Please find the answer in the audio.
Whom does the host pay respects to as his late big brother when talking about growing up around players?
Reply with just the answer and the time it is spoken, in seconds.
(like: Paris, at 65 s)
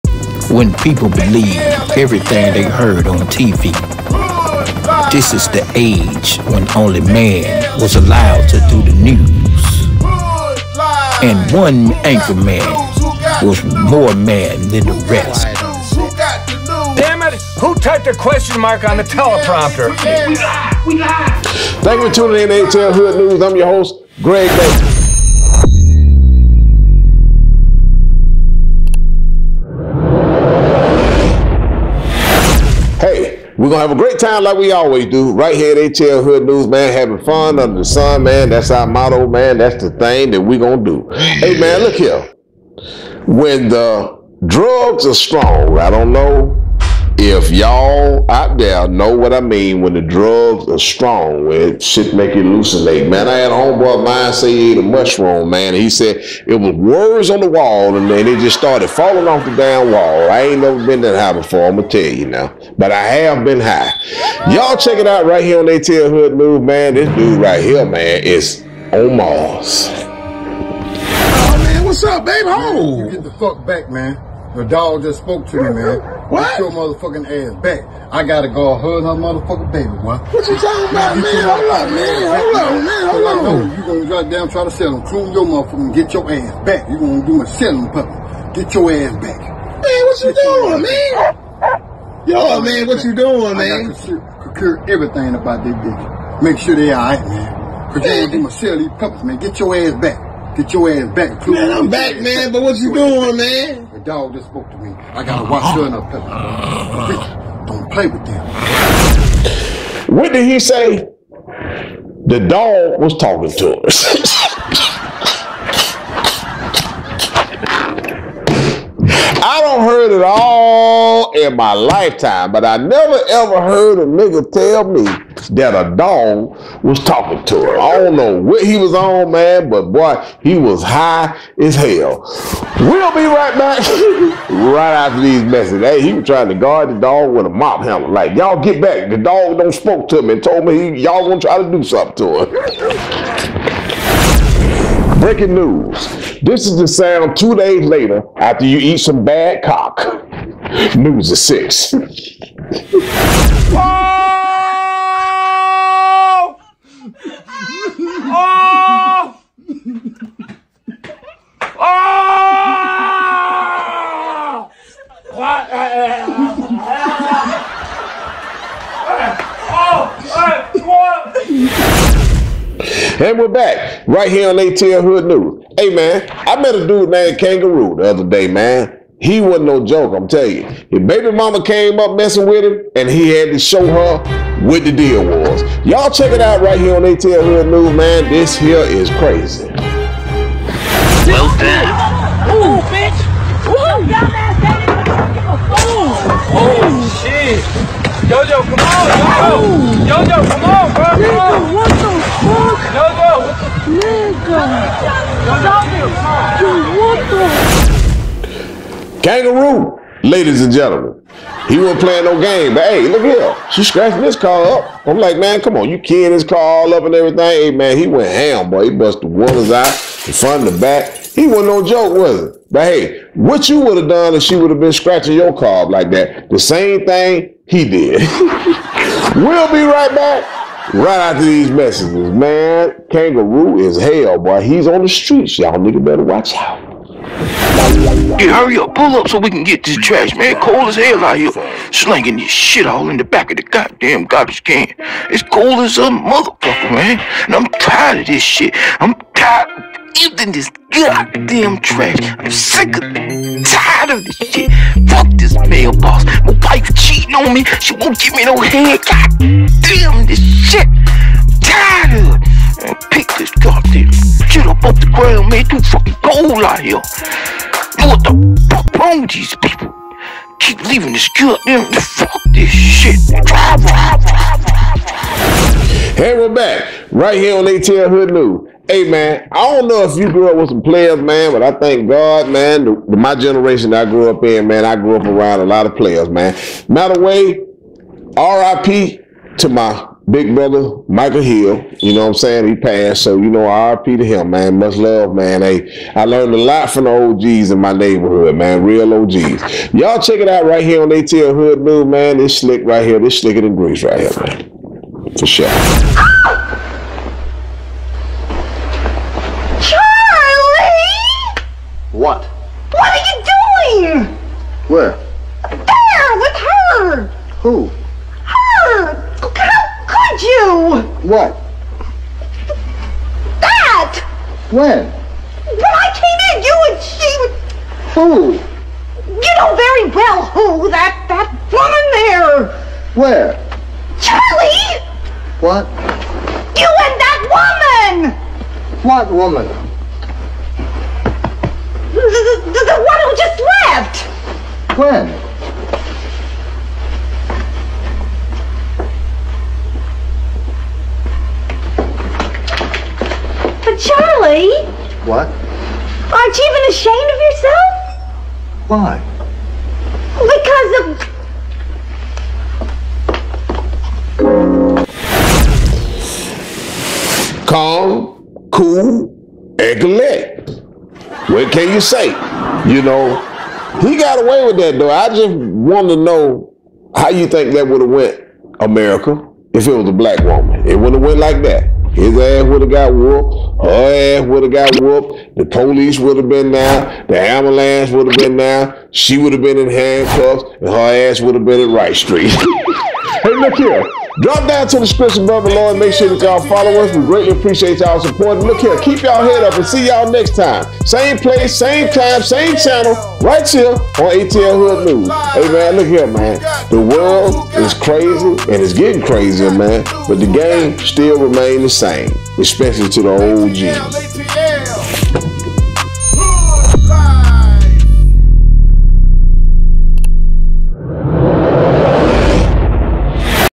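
Michael Hill, at 291 s.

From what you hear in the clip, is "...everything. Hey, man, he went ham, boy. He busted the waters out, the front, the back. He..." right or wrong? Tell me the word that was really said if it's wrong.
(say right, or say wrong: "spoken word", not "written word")
right.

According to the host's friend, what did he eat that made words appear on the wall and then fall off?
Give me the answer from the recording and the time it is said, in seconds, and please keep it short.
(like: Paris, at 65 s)
A mushroom, at 54 s.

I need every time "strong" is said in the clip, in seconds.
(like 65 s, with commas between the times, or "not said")
45 s, 50 s.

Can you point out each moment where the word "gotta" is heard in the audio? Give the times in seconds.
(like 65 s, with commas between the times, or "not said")
78 s, 93 s.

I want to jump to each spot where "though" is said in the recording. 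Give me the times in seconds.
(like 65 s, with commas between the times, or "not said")
374 s.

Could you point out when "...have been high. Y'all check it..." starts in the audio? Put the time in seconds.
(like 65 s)
63 s.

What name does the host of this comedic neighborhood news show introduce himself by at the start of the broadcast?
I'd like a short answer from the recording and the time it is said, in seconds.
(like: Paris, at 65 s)
Greg Baker, at 24 s.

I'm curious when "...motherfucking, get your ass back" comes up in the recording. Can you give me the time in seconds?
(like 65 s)
85 s.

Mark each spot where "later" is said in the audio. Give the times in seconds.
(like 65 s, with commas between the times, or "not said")
147 s.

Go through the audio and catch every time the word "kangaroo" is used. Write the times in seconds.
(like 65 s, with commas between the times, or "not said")
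177 s, 209 s, 233 s.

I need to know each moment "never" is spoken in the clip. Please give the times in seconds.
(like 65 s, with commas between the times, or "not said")
60 s, 122 s.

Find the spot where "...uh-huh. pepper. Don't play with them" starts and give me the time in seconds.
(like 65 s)
105 s.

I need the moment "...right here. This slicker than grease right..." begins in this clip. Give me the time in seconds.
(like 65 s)
302 s.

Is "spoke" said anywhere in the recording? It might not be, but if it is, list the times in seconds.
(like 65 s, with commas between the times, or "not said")
75 s, 104 s, 139 s.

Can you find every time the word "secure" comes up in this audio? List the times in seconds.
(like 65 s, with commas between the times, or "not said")
93 s.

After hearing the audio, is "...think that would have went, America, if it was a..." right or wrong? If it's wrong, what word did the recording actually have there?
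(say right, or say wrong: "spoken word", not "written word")
right.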